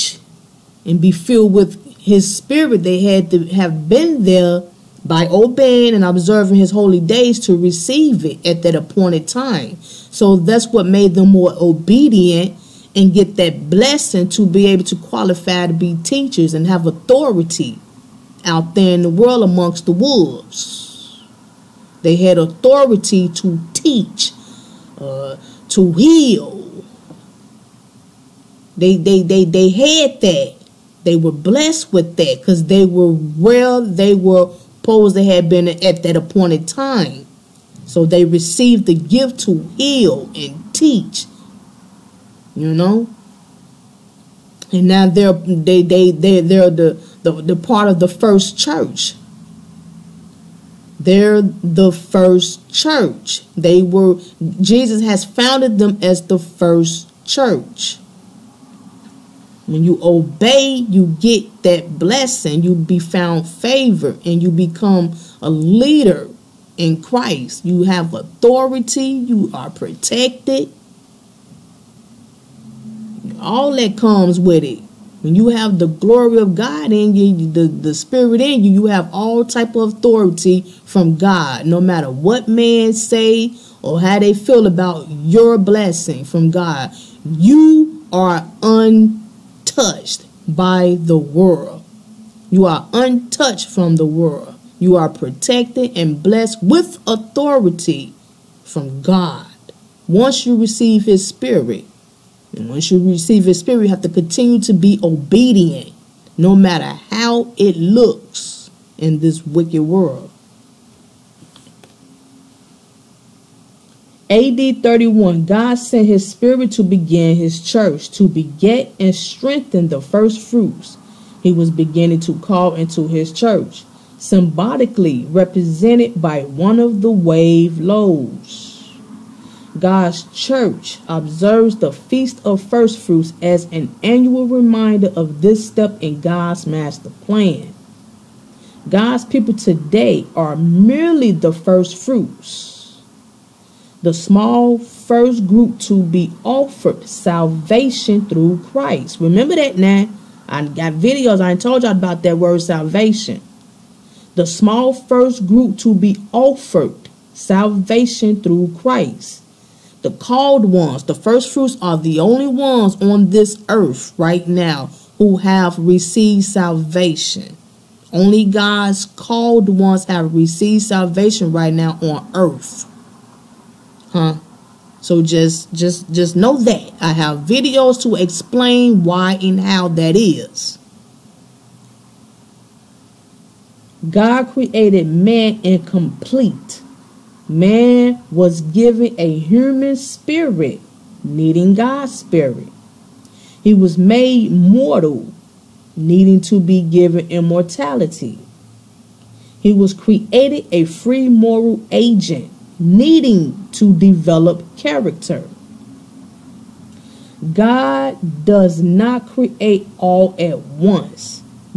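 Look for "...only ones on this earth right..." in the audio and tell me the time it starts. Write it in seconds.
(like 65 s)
162 s.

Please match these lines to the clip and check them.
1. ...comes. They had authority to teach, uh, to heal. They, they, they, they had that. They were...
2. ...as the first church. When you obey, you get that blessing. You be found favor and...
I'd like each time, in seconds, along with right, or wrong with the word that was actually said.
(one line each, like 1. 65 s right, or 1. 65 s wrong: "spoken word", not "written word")
1. 19 s wrong: "wolves", not "comes"
2. 56 s right.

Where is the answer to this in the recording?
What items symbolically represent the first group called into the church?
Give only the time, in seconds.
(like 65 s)
127 s.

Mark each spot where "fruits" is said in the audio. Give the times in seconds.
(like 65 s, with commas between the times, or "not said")
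120 s, 132 s, 141 s, 161 s.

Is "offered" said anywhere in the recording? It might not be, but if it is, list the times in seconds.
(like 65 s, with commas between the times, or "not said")
146 s, 156 s.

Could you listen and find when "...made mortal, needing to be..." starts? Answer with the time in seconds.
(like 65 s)
193 s.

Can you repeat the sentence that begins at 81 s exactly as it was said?
No matter what man say or how they feel about your blessing from God, you are un untouched by the world.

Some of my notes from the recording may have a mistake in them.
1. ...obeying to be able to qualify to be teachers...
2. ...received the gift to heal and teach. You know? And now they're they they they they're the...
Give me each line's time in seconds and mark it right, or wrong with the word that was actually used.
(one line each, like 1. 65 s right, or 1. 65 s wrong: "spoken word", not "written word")
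1. 13 s wrong: "blessing", not "obeying"
2. 38 s right.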